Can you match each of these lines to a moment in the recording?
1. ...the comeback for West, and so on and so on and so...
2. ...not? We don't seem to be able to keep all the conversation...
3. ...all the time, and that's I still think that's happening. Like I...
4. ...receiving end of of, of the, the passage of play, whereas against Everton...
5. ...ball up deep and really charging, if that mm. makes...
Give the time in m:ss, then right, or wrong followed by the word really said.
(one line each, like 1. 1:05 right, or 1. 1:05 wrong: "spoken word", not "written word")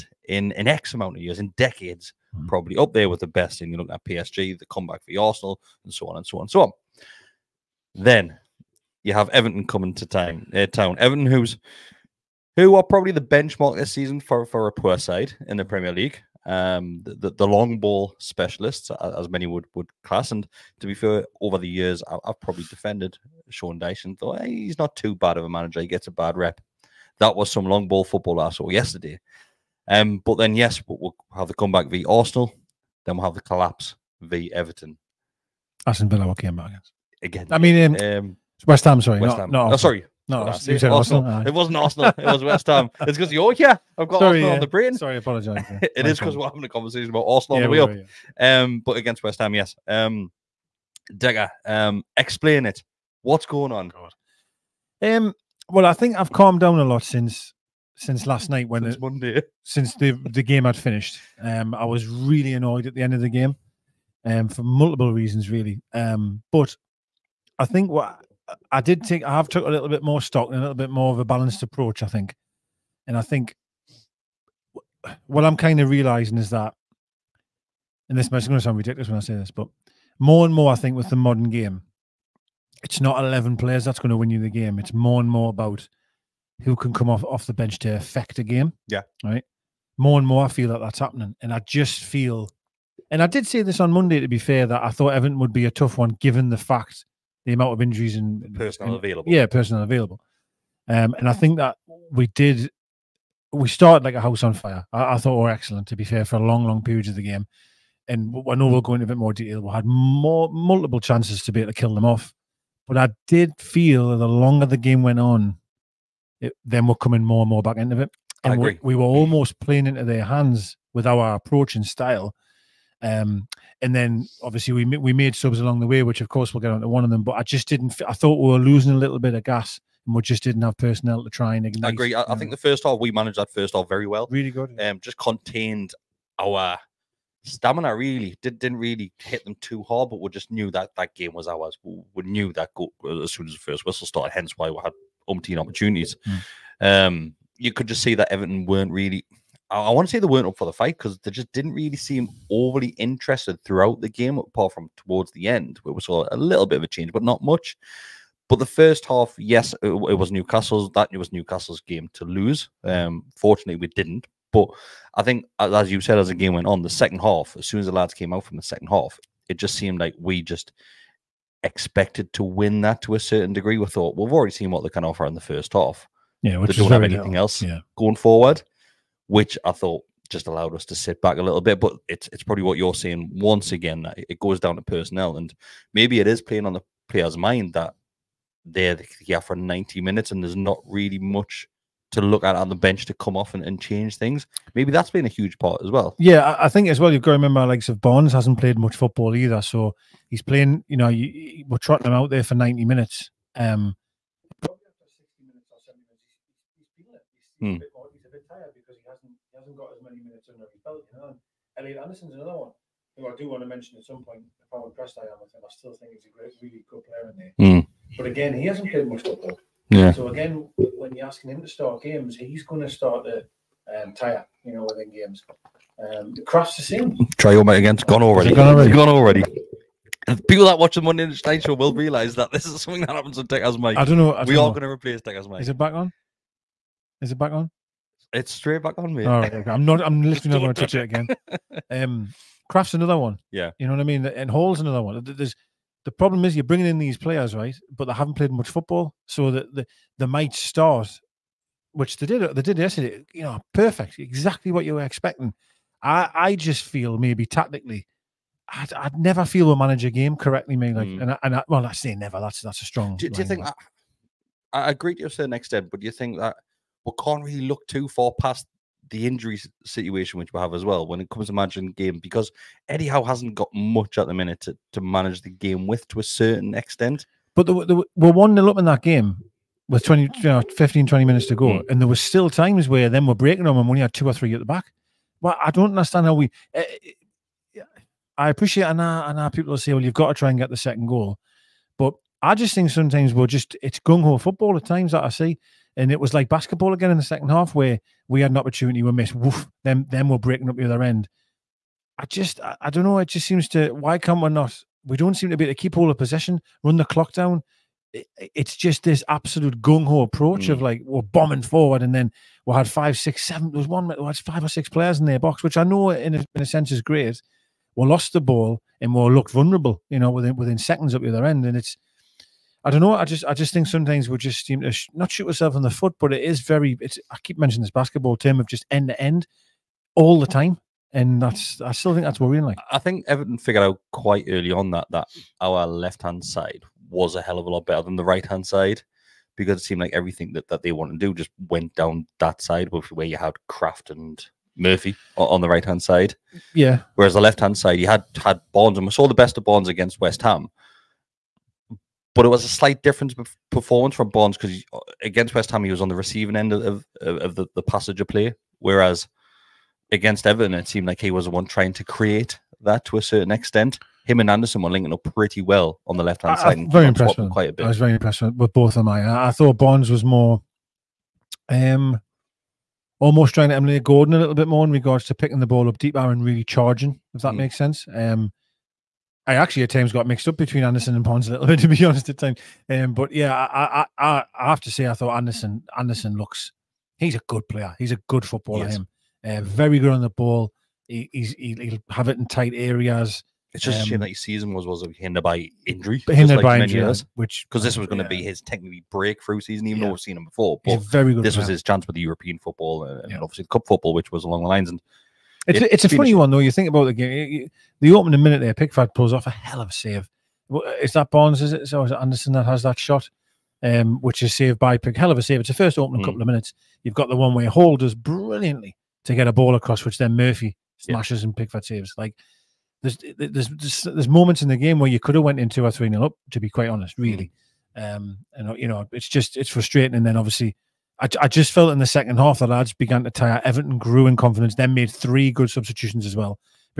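1. 0:04 wrong: "Arsenal", not "West"
2. 5:04 wrong: "possession", not "conversation"
3. 5:30 wrong: "worrying", not "happening"
4. 5:56 right
5. 6:15 right.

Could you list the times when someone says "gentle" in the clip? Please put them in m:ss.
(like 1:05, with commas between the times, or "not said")
not said.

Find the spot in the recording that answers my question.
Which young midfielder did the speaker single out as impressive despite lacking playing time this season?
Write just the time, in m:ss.
3:31.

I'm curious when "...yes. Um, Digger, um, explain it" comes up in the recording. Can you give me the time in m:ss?
0:49.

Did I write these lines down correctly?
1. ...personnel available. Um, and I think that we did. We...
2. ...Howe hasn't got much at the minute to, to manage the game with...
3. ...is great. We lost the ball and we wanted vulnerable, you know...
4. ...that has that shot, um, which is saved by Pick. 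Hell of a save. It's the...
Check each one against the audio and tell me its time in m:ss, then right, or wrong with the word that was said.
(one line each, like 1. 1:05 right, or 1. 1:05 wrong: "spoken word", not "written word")
1. 1:39 right
2. 4:33 right
3. 5:16 wrong: "looked", not "wanted"
4. 6:52 right.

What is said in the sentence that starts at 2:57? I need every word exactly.
going forward which I thought just allowed us to sit back a little bit.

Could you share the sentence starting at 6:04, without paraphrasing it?
Him and Anderson were linking up pretty well on the left hand side.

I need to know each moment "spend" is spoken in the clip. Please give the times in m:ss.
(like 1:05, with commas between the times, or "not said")
not said.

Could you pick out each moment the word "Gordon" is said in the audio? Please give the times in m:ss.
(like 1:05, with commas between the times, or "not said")
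6:14.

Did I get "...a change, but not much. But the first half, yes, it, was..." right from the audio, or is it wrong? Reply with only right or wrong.
right.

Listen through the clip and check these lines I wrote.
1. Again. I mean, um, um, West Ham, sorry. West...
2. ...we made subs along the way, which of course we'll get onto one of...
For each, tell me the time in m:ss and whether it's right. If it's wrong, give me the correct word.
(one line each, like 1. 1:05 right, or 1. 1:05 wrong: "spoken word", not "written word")
1. 0:37 right
2. 2:04 right.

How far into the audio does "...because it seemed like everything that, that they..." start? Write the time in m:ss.
5:39.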